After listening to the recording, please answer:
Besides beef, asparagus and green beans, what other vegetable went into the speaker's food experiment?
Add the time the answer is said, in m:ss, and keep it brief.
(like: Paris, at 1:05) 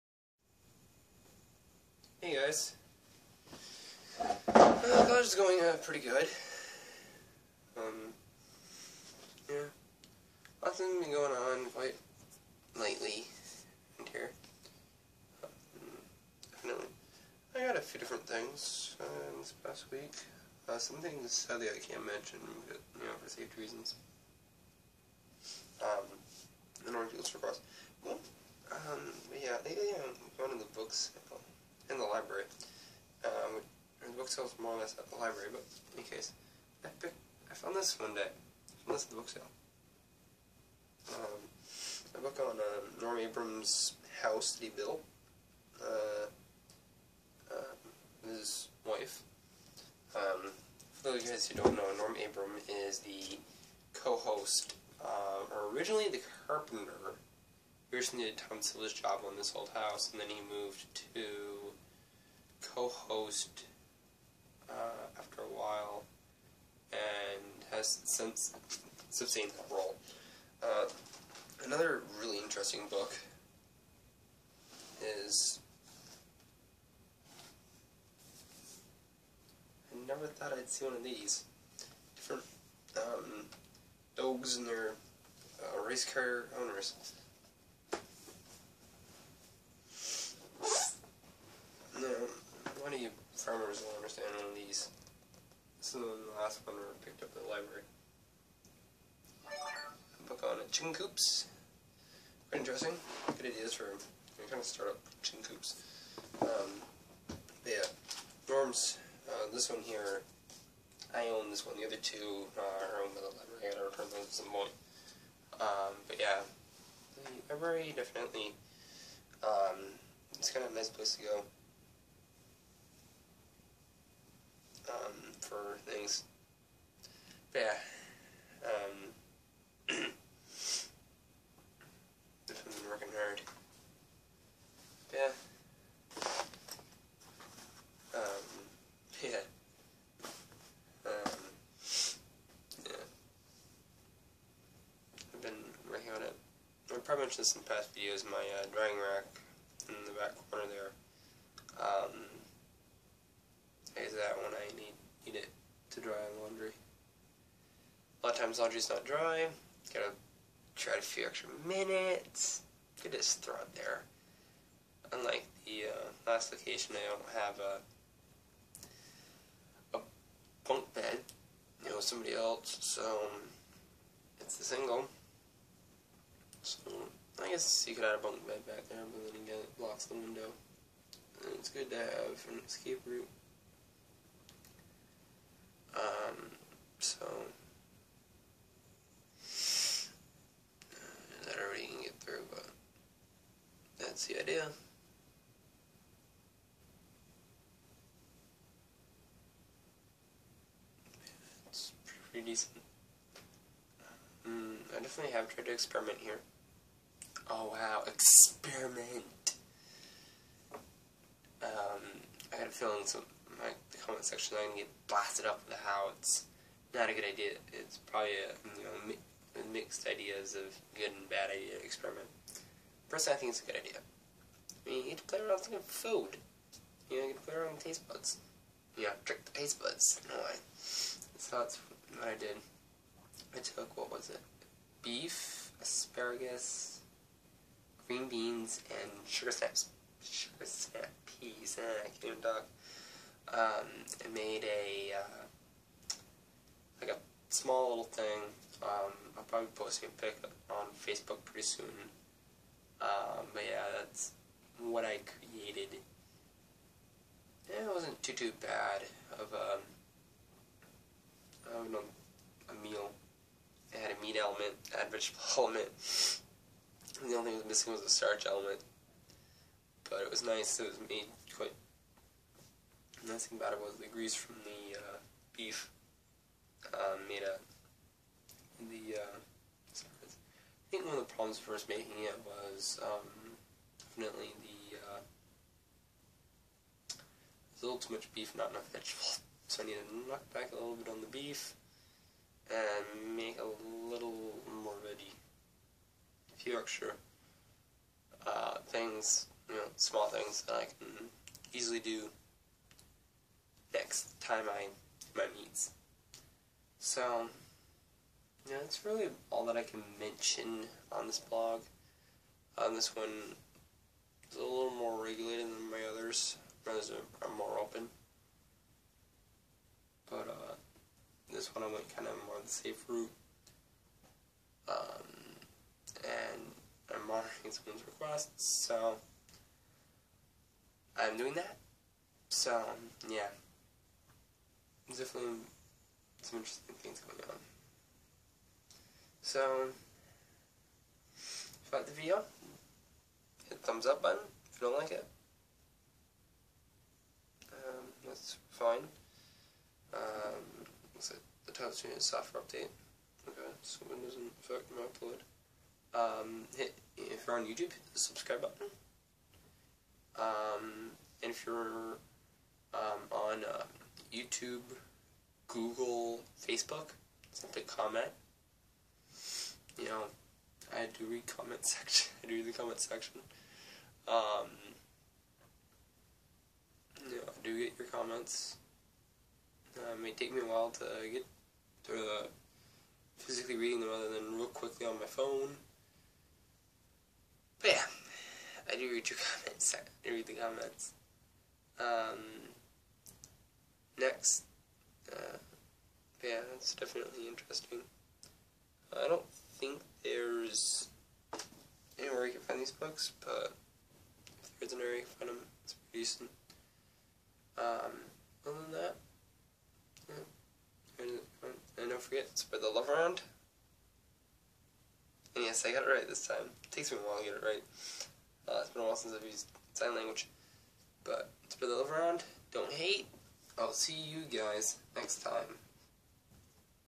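Sugar snap peas, at 4:00.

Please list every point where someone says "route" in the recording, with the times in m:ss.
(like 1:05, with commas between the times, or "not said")
3:03, 5:23.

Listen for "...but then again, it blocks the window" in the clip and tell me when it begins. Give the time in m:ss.
2:59.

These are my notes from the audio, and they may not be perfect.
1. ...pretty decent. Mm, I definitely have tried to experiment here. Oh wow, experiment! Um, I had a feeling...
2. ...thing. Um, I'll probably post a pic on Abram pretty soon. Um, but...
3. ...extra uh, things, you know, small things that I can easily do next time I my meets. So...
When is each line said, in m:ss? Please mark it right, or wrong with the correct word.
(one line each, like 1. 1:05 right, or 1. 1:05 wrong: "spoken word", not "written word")
1. 3:22 right
2. 4:08 wrong: "Facebook", not "Abram"
3. 4:56 right.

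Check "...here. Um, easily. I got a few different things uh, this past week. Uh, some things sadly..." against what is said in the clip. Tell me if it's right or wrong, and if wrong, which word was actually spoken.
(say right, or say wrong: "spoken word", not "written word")
wrong: "definitely", not "easily".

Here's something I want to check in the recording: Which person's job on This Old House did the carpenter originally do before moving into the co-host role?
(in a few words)
Tom Silva.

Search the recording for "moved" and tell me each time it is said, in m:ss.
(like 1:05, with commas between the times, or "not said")
1:00.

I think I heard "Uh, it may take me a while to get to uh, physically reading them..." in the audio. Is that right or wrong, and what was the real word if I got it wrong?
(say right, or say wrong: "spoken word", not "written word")
right.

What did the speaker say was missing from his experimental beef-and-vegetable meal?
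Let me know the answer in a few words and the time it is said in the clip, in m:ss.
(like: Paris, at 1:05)
A starch element, at 4:28.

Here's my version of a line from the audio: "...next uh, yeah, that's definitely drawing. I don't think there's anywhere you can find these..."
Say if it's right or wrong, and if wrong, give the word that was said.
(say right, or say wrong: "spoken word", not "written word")
wrong: "interesting", not "drawing".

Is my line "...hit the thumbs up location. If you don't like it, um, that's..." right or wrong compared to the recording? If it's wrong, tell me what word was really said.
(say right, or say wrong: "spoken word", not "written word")
wrong: "button", not "location".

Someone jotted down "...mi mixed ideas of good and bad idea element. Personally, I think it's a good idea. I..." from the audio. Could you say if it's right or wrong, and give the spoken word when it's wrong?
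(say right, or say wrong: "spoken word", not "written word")
wrong: "experiment", not "element".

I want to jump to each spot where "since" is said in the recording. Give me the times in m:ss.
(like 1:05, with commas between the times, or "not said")
1:08, 6:59.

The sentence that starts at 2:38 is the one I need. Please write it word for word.
A lot of times laundry's not dry.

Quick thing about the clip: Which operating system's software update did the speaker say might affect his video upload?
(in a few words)
Windows.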